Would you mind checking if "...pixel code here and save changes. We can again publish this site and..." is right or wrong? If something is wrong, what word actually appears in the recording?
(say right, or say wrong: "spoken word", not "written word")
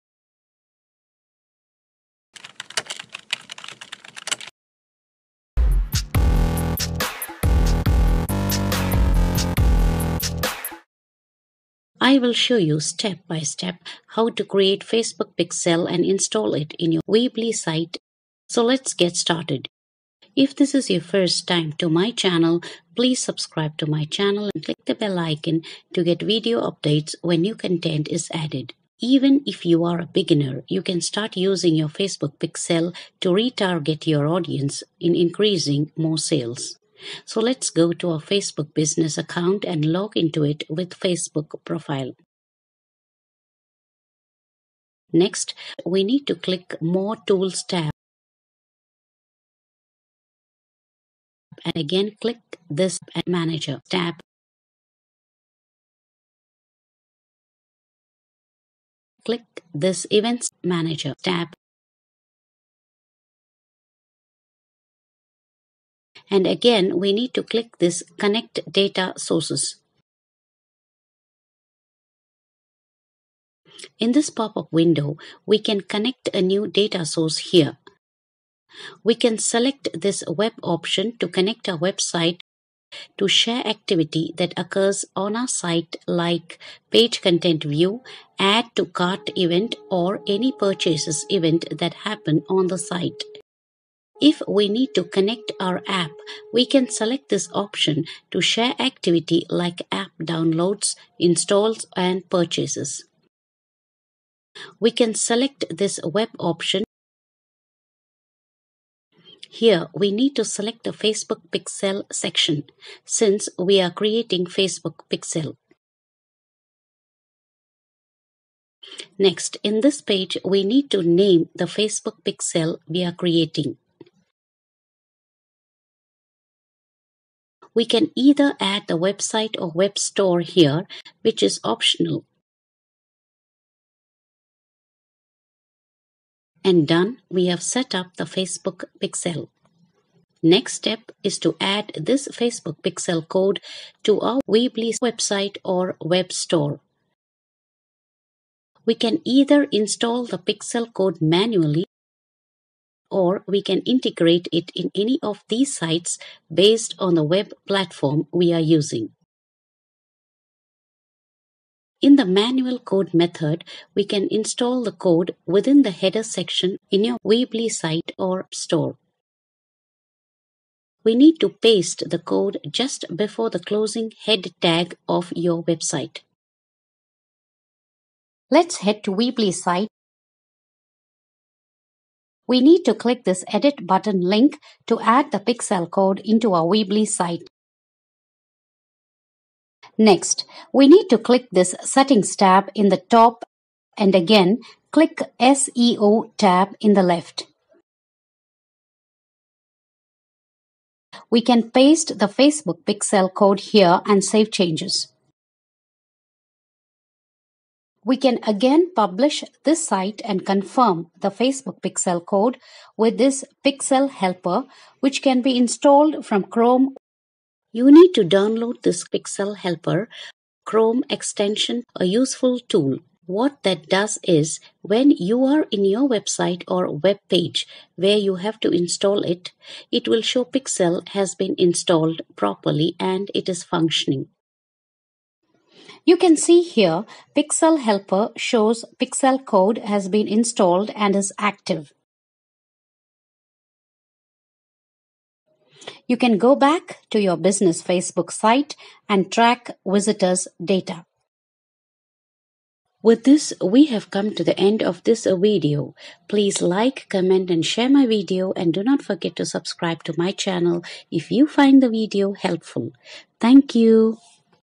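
right.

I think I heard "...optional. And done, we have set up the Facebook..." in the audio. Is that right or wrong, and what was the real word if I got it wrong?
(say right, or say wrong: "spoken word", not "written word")
right.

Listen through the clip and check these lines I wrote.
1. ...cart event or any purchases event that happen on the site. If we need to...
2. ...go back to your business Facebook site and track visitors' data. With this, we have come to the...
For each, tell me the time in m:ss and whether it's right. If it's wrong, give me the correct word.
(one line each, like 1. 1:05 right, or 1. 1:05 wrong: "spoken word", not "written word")
1. 1:28 right
2. 4:06 right.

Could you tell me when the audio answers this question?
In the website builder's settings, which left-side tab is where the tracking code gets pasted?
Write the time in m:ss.
3:15.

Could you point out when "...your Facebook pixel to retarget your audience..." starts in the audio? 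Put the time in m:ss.
0:31.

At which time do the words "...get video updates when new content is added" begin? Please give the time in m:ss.
0:26.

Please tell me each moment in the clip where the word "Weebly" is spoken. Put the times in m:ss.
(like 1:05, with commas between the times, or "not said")
0:17, 2:24, 2:47, 2:59, 3:06.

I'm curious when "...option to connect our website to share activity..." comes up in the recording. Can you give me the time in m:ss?
1:20.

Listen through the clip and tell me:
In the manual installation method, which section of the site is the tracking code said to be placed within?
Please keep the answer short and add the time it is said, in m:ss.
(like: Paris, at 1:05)
header section, at 2:45.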